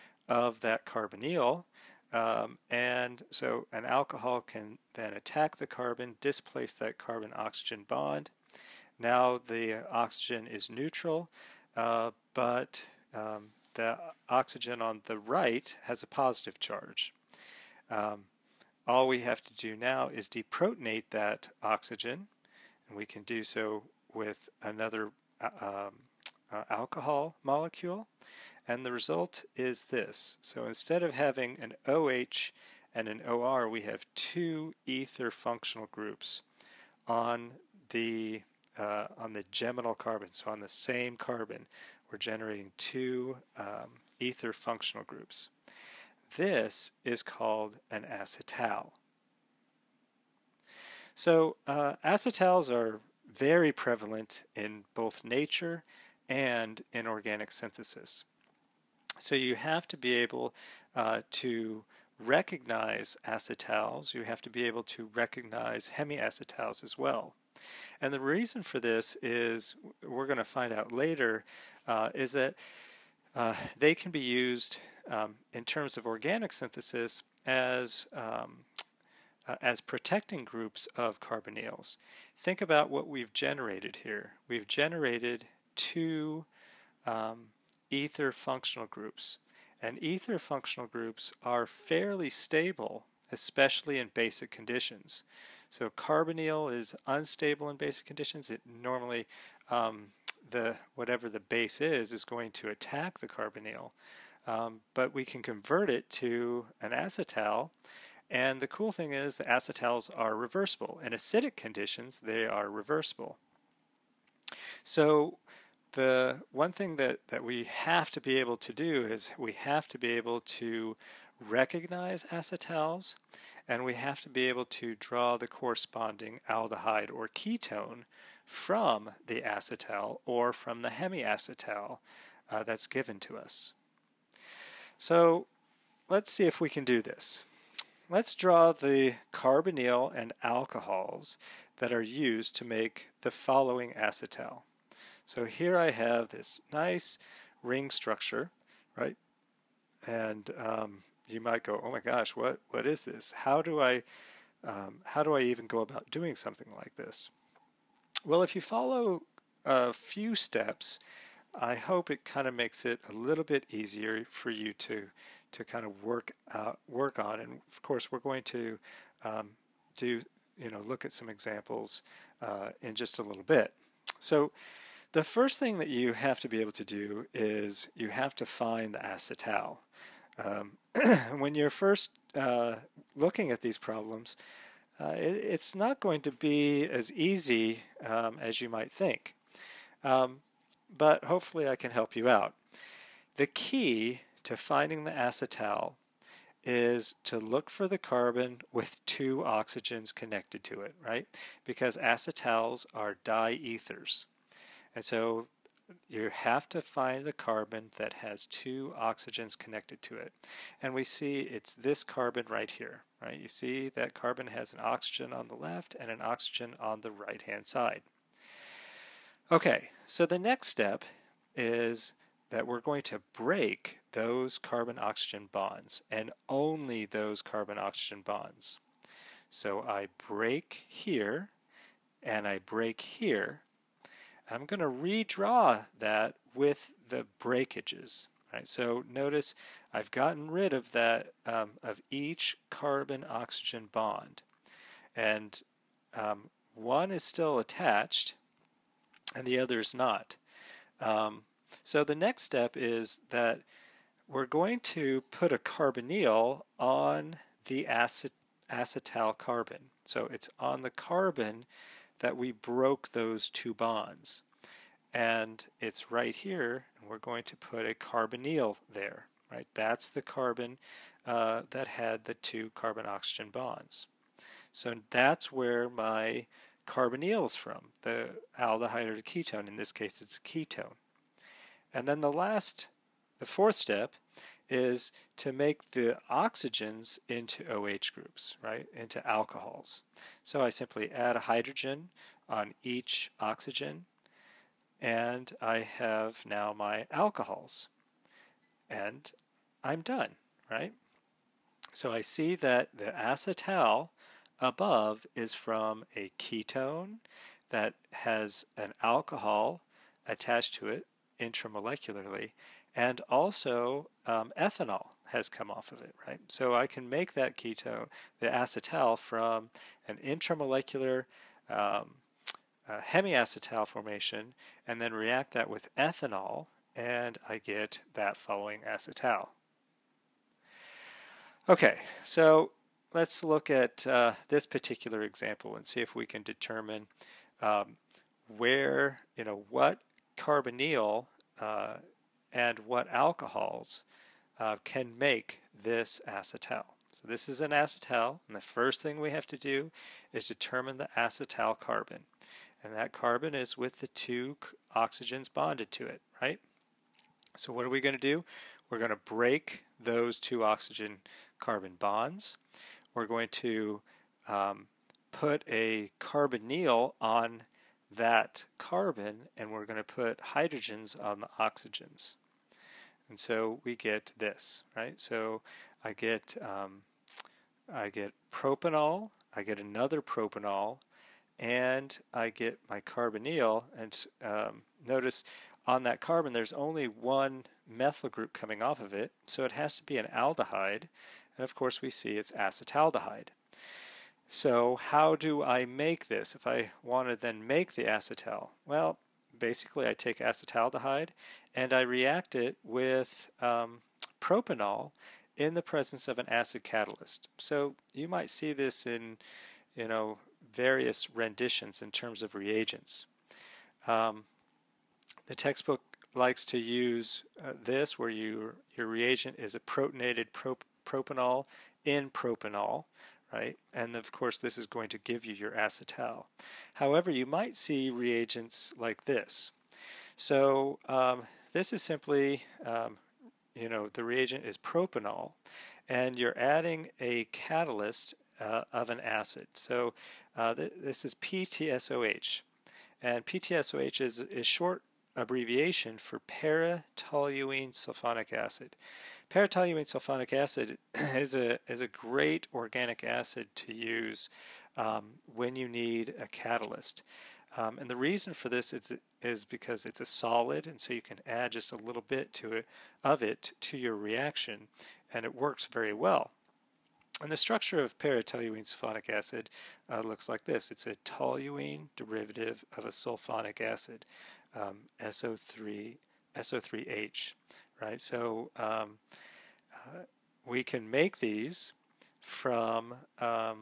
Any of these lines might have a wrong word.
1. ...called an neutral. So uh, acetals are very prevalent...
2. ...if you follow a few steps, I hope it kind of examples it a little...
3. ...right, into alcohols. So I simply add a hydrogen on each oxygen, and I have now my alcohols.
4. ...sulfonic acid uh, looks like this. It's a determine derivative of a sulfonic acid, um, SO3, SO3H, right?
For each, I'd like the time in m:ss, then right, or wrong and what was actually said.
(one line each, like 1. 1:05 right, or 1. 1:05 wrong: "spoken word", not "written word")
1. 0:47 wrong: "acetal", not "neutral"
2. 2:38 wrong: "makes", not "examples"
3. 4:48 right
4. 7:48 wrong: "toluene", not "determine".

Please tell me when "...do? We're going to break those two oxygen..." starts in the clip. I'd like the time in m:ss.
5:58.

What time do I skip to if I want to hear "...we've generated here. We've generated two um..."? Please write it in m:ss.
1:23.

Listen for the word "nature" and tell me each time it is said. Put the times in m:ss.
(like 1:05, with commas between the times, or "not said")
0:55.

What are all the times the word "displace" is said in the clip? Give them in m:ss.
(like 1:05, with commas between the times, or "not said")
0:06.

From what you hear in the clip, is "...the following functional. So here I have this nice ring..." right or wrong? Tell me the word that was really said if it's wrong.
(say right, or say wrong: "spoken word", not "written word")
wrong: "acetal", not "functional".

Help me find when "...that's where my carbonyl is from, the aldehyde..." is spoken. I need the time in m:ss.
4:35.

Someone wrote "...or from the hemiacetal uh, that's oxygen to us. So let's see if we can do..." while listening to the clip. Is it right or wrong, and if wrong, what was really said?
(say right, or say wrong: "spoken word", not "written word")
wrong: "given", not "oxygen".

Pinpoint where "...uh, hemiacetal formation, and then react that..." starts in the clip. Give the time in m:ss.
5:22.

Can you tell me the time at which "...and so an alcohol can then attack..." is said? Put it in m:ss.
0:02.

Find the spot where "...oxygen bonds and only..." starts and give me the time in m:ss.
3:44.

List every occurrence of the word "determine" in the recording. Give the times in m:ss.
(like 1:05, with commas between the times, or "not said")
5:36, 5:50.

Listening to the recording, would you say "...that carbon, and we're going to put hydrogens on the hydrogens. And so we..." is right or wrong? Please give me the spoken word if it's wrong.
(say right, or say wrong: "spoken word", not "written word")
wrong: "oxygens", not "hydrogens".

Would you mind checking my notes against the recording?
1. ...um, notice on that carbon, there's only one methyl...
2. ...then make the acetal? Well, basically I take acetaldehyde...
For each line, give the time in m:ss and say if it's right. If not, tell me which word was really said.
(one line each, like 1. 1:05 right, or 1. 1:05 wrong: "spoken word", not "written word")
1. 6:24 right
2. 6:37 right.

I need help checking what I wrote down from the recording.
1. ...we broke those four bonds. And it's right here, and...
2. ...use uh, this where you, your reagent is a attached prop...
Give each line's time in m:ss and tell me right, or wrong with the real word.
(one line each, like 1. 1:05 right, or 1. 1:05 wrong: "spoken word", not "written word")
1. 4:22 wrong: "two", not "four"
2. 6:56 wrong: "protonated", not "attached".